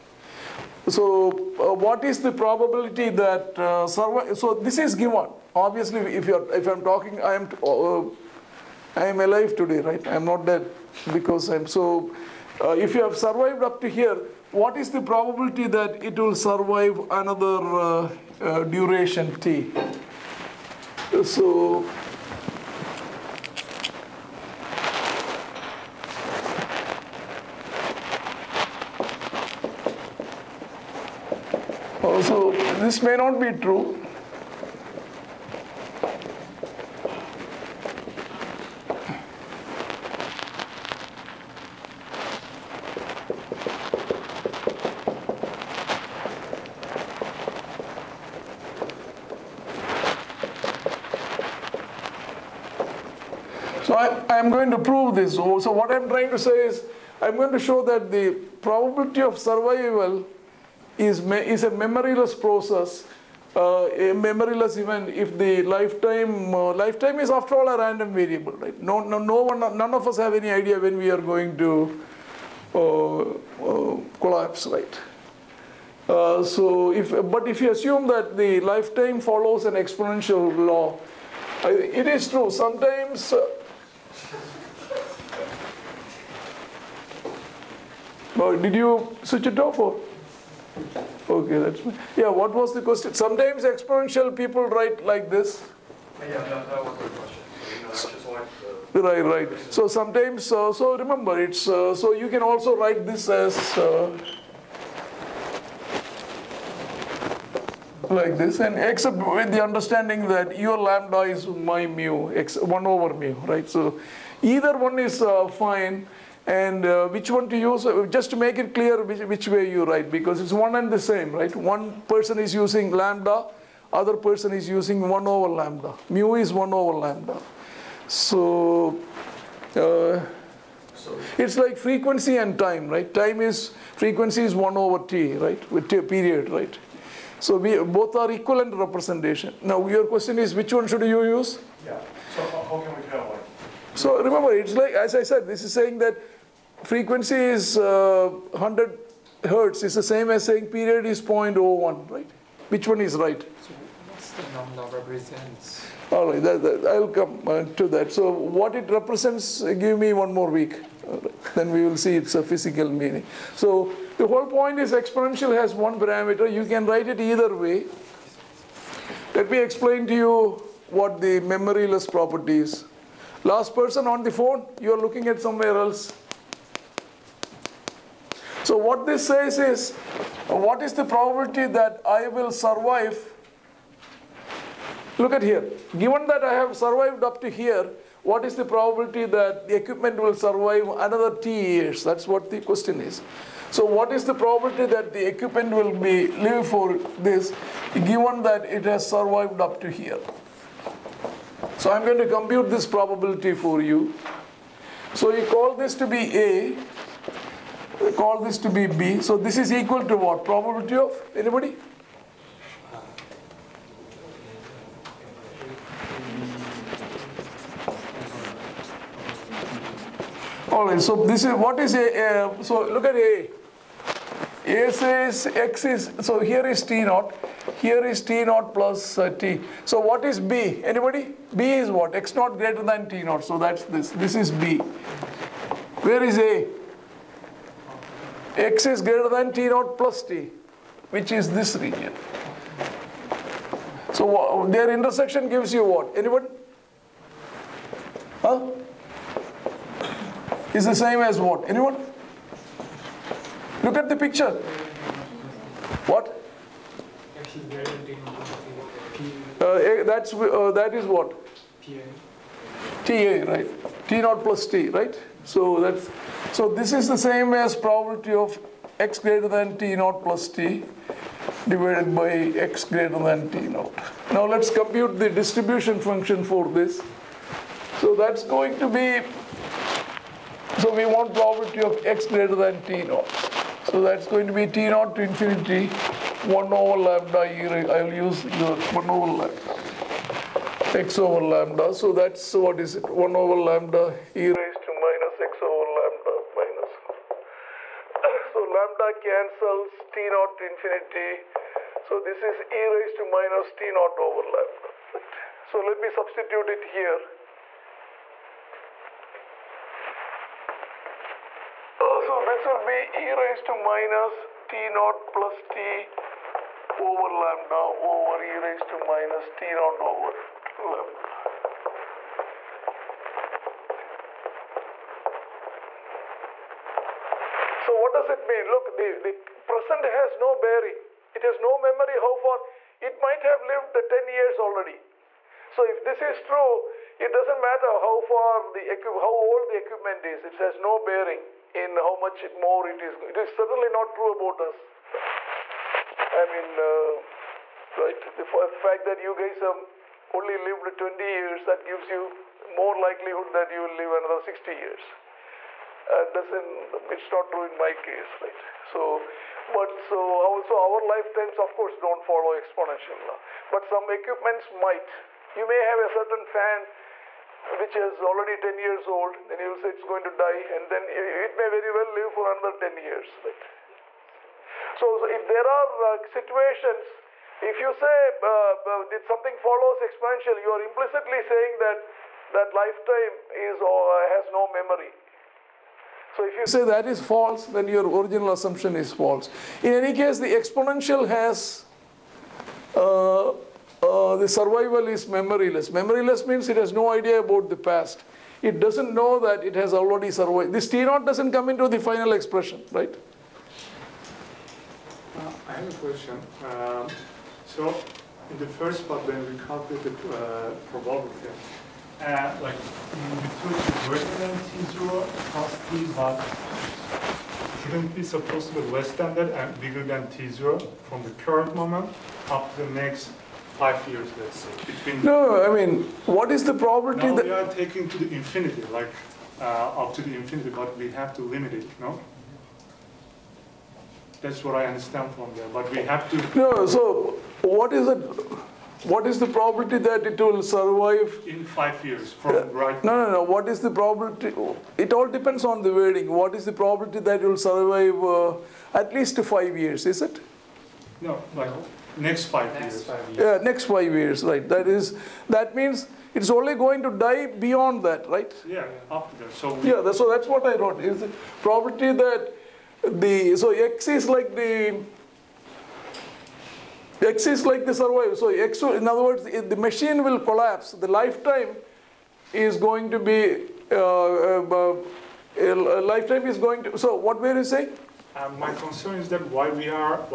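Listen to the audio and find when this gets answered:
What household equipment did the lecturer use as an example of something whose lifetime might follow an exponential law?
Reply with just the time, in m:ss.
6:06.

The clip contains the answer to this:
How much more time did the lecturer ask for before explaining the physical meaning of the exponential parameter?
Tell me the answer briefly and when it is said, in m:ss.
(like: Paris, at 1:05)
one more week, at 2:40.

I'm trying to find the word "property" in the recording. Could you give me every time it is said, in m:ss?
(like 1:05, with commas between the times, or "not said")
2:52, 7:41.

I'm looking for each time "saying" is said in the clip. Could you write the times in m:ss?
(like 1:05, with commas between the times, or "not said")
2:25, 2:30, 6:21, 7:57.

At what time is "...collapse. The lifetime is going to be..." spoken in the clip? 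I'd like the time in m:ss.
7:50.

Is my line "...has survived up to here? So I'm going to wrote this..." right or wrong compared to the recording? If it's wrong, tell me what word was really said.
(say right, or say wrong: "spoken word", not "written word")
wrong: "compute", not "wrote".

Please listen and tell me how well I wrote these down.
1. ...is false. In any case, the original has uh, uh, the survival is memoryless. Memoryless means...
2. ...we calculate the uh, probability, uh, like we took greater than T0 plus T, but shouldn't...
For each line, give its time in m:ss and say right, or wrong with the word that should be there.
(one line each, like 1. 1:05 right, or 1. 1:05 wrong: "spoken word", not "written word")
1. 6:28 wrong: "exponential", not "original"
2. 6:49 right.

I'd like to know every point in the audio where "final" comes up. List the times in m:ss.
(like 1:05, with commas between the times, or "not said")
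6:41.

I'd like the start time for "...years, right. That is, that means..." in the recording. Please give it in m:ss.
7:34.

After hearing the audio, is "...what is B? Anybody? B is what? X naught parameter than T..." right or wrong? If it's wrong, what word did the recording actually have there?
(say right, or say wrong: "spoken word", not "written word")
wrong: "greater", not "parameter".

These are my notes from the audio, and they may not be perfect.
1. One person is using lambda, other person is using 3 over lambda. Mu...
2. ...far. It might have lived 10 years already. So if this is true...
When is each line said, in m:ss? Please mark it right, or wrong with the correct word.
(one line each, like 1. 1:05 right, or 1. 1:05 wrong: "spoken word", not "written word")
1. 2:01 wrong: "1", not "3"
2. 5:32 right.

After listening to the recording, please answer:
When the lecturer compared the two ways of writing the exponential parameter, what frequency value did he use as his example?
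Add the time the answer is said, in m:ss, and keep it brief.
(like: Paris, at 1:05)
100 hertz, at 2:28.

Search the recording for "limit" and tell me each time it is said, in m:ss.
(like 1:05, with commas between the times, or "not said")
7:11.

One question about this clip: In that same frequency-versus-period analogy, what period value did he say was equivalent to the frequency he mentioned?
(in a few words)
0.01.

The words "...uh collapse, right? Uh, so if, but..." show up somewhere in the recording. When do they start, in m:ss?
1:13.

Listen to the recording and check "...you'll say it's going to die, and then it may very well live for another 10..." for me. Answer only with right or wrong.
right.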